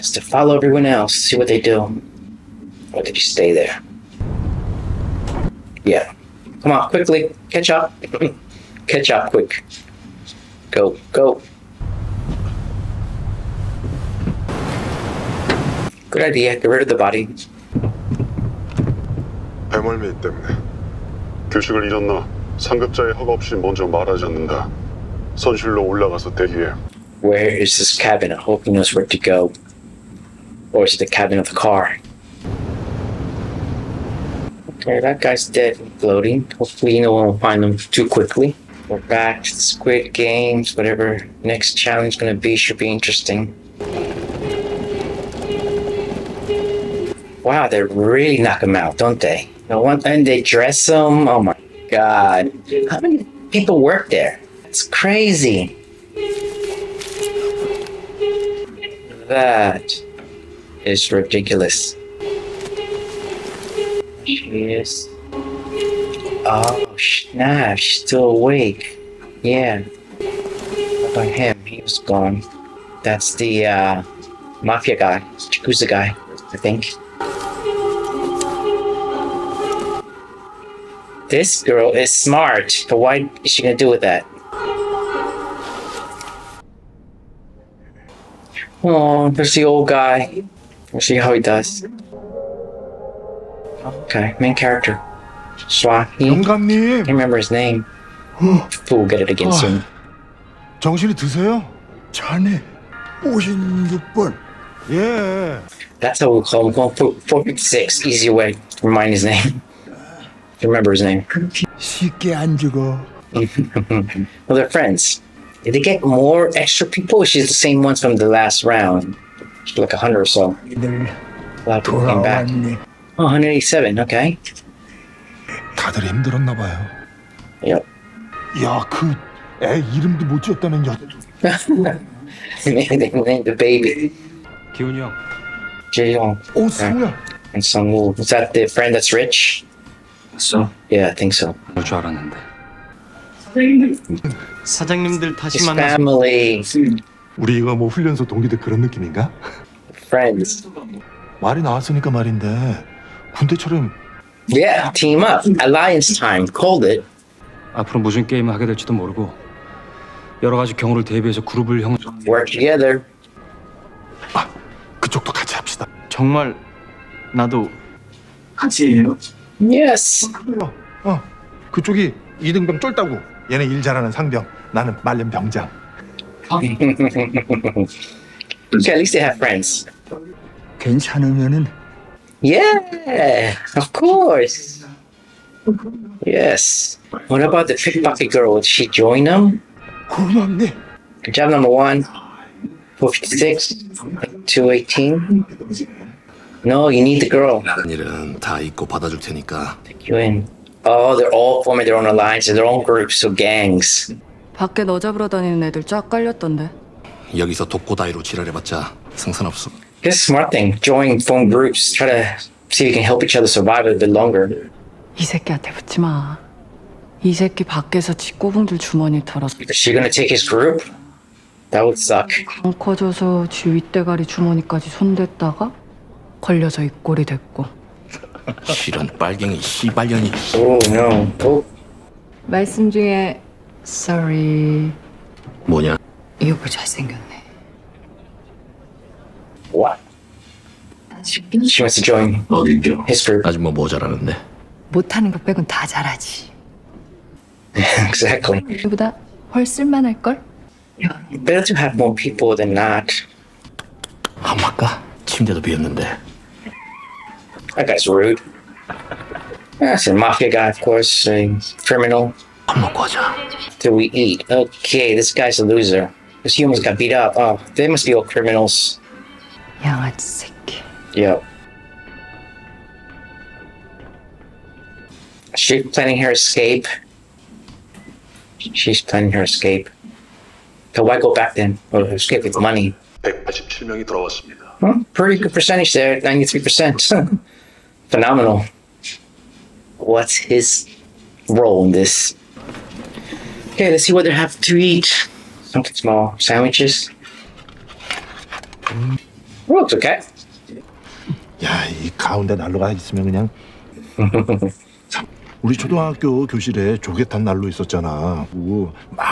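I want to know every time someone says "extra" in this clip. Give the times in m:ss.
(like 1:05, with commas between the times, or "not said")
1:56.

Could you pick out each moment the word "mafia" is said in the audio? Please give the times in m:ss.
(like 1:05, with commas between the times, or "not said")
1:14, 4:20.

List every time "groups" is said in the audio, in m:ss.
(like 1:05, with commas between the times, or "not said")
3:22, 3:31, 3:40, 4:03.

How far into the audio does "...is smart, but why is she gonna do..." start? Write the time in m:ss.
1:21.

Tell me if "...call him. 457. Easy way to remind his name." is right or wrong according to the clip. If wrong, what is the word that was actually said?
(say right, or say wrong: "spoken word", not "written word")
wrong: "456", not "457".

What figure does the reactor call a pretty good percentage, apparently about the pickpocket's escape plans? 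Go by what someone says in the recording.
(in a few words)
93%.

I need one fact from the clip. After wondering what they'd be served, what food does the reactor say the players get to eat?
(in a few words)
Sandwiches.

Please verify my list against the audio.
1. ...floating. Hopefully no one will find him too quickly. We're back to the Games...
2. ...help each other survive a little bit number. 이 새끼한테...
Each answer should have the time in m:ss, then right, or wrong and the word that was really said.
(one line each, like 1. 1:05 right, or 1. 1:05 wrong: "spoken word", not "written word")
1. 0:35 wrong: "Squid", not "Games"
2. 3:33 wrong: "longer", not "number".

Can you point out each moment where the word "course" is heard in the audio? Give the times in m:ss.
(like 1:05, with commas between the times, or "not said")
3:03, 4:20.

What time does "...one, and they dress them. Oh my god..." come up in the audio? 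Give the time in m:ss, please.
0:49.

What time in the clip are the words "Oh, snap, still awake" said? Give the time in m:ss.
1:06.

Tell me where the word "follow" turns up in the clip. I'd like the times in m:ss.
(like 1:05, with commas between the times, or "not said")
0:00.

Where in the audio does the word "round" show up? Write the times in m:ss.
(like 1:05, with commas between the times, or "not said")
1:58.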